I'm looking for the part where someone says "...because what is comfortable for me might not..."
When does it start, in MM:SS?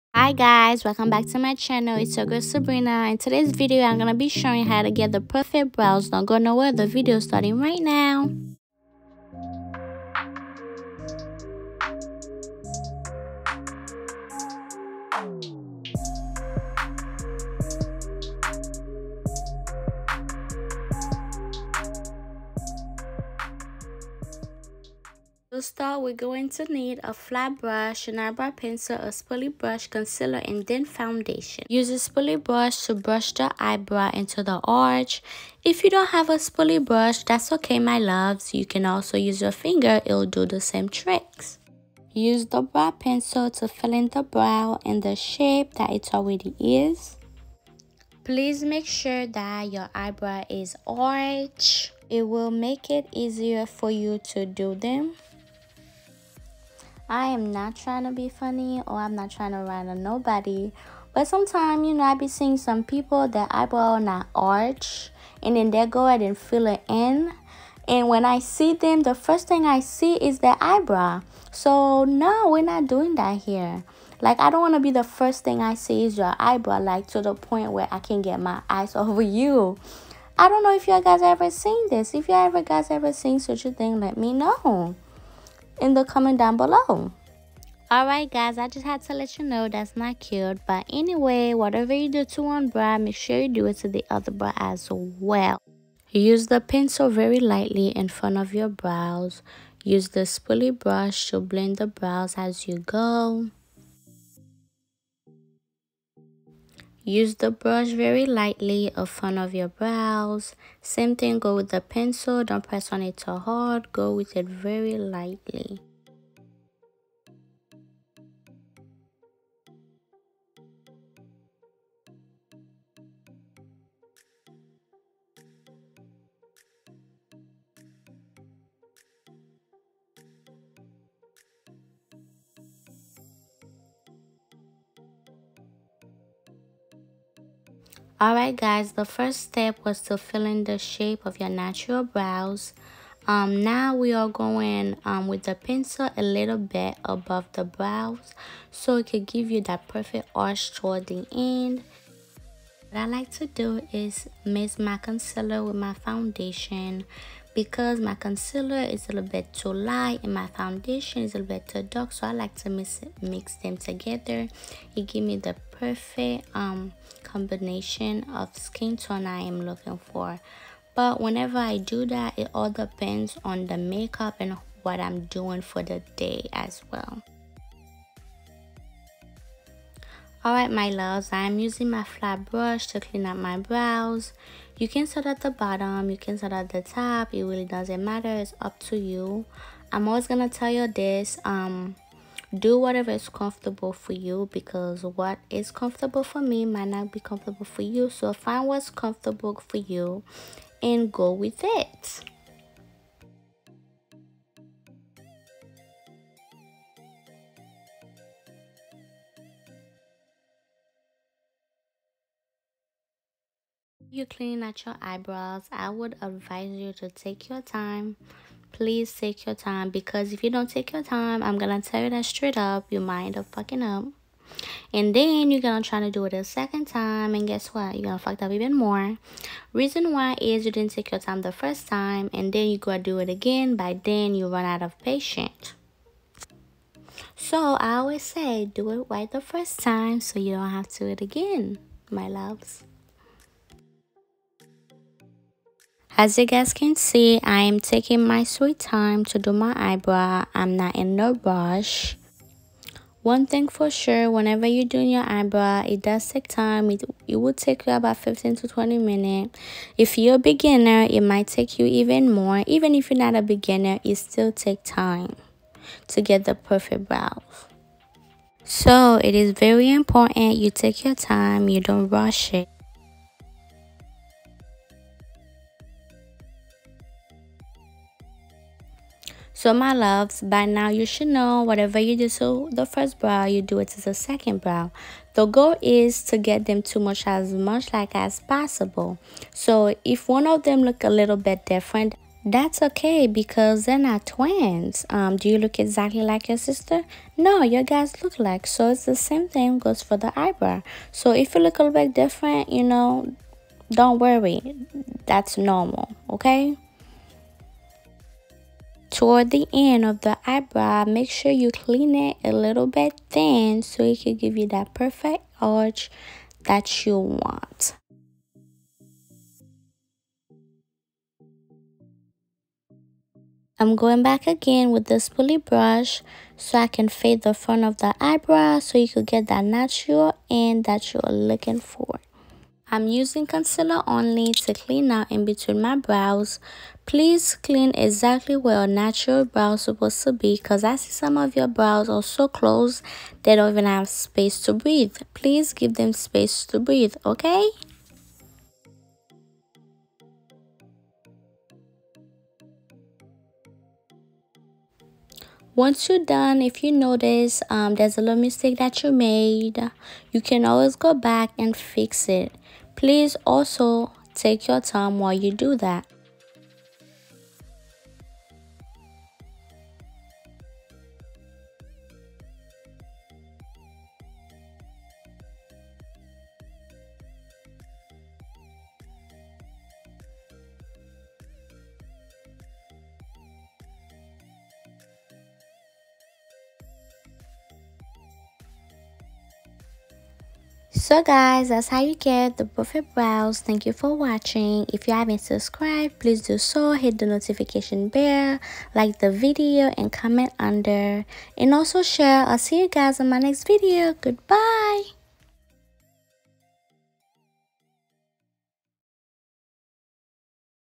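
03:14.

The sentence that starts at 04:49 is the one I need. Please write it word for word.
So if one of them look a little bit different, that's okay because they're not twins.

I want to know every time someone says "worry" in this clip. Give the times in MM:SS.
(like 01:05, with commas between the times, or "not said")
05:04.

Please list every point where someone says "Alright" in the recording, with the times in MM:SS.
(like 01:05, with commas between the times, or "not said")
01:27, 02:18, 03:00.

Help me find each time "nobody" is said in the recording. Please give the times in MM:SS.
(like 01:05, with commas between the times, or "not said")
01:00.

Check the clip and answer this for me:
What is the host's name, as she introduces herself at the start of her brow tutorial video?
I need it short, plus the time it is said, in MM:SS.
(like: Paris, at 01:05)
Sabrina, at 00:02.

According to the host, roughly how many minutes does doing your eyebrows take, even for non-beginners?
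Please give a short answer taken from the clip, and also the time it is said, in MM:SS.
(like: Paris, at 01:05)
15 to 20 minutes, at 04:18.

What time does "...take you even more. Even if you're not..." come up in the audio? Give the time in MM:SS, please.
04:21.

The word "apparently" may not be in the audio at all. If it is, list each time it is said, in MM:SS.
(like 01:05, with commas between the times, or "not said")
not said.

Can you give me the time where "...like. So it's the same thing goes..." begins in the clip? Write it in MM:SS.
04:58.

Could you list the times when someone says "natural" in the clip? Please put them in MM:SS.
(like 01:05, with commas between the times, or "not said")
02:21, 05:29, 05:38.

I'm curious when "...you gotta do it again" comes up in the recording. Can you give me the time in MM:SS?
03:52.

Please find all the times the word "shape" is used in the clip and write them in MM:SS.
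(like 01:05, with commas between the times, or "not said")
00:45, 02:20.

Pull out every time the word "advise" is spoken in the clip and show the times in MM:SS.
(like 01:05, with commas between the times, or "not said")
03:36.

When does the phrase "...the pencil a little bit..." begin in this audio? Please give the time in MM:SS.
02:25.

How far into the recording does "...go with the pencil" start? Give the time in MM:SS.
01:51.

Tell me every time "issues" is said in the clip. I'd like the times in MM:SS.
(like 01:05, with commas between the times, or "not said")
not said.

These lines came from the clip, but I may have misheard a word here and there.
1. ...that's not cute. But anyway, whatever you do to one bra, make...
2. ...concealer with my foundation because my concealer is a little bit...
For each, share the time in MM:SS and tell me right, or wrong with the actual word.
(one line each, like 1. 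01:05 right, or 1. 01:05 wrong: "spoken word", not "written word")
1. 01:29 right
2. 02:34 right.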